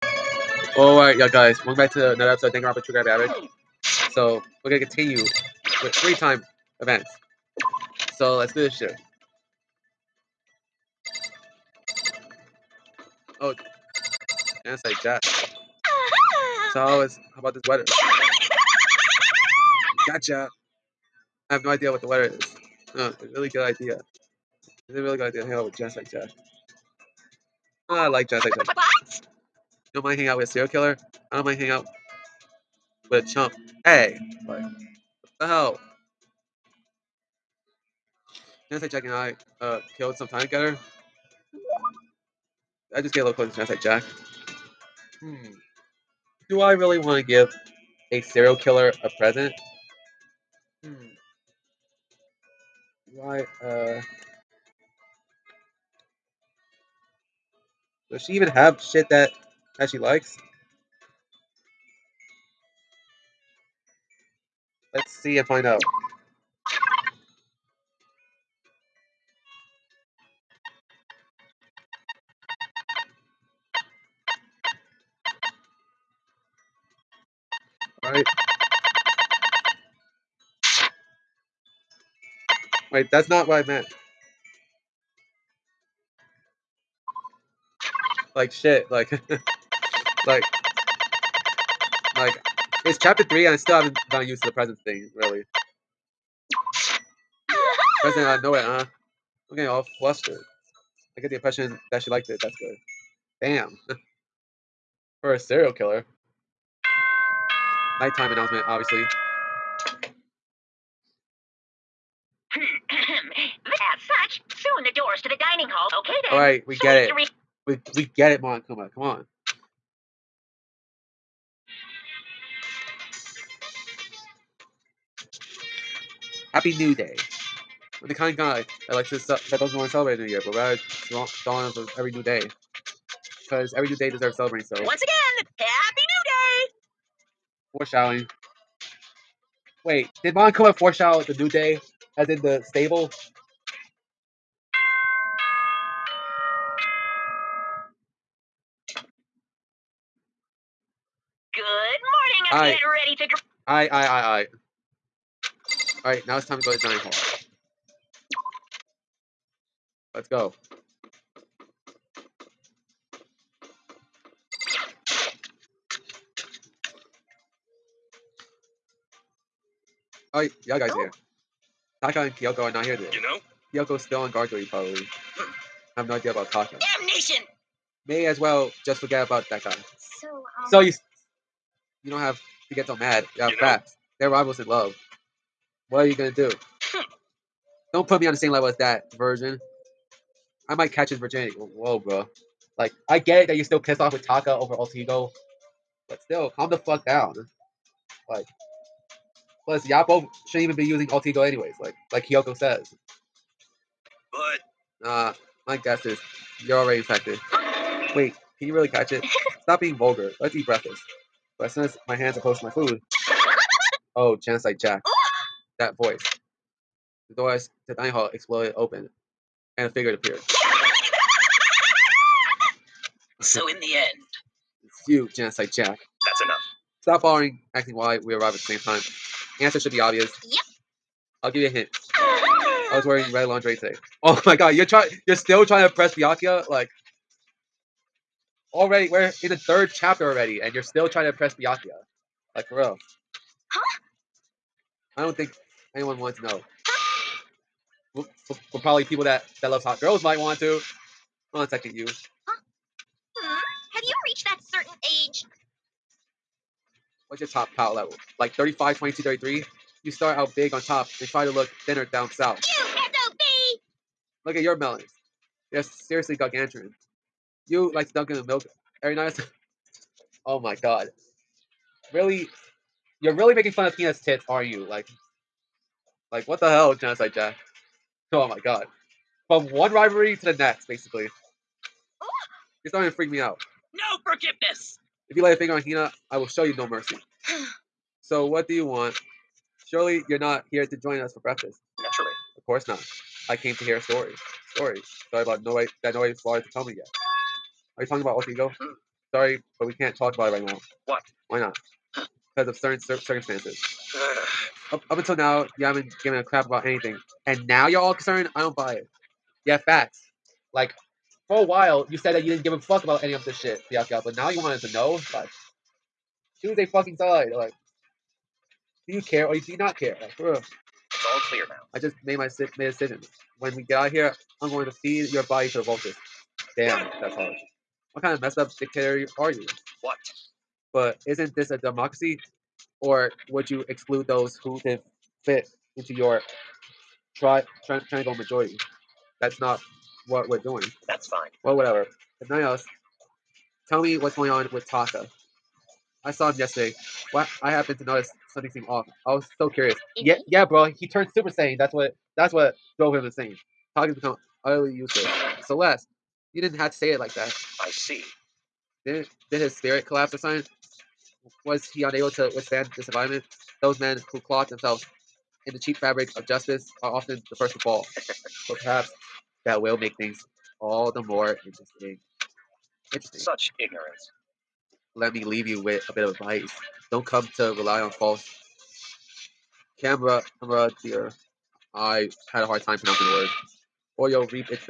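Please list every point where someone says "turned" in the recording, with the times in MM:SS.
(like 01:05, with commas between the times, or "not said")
05:51.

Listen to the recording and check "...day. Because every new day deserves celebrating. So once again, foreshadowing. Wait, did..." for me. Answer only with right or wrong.
right.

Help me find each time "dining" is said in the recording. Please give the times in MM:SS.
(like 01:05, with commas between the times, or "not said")
02:36, 03:37.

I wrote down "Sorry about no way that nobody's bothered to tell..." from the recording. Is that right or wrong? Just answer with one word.
right.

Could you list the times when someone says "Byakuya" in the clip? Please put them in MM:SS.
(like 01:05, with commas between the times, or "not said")
03:56, 04:01, 05:13.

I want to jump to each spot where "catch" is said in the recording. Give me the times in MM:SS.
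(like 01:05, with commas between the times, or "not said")
03:10, 03:28.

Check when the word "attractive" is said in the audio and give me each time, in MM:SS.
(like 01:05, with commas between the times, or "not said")
not said.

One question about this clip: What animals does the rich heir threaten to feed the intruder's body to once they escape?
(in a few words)
Vultures.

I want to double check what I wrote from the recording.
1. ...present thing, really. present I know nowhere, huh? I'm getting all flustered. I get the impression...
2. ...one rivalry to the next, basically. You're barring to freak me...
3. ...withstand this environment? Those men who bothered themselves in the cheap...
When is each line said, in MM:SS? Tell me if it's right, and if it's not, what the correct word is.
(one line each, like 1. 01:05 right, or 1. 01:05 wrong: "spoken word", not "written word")
1. 01:34 right
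2. 04:39 wrong: "starting", not "barring"
3. 06:02 wrong: "clawed", not "bothered".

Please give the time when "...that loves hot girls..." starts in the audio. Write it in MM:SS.
04:09.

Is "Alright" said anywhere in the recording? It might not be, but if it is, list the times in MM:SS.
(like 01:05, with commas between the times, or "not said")
00:00, 01:18, 02:36.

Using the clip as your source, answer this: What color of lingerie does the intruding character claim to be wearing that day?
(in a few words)
Red.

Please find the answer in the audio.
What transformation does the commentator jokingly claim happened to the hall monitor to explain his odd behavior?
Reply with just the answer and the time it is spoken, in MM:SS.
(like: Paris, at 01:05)
Super Saiyan, at 05:51.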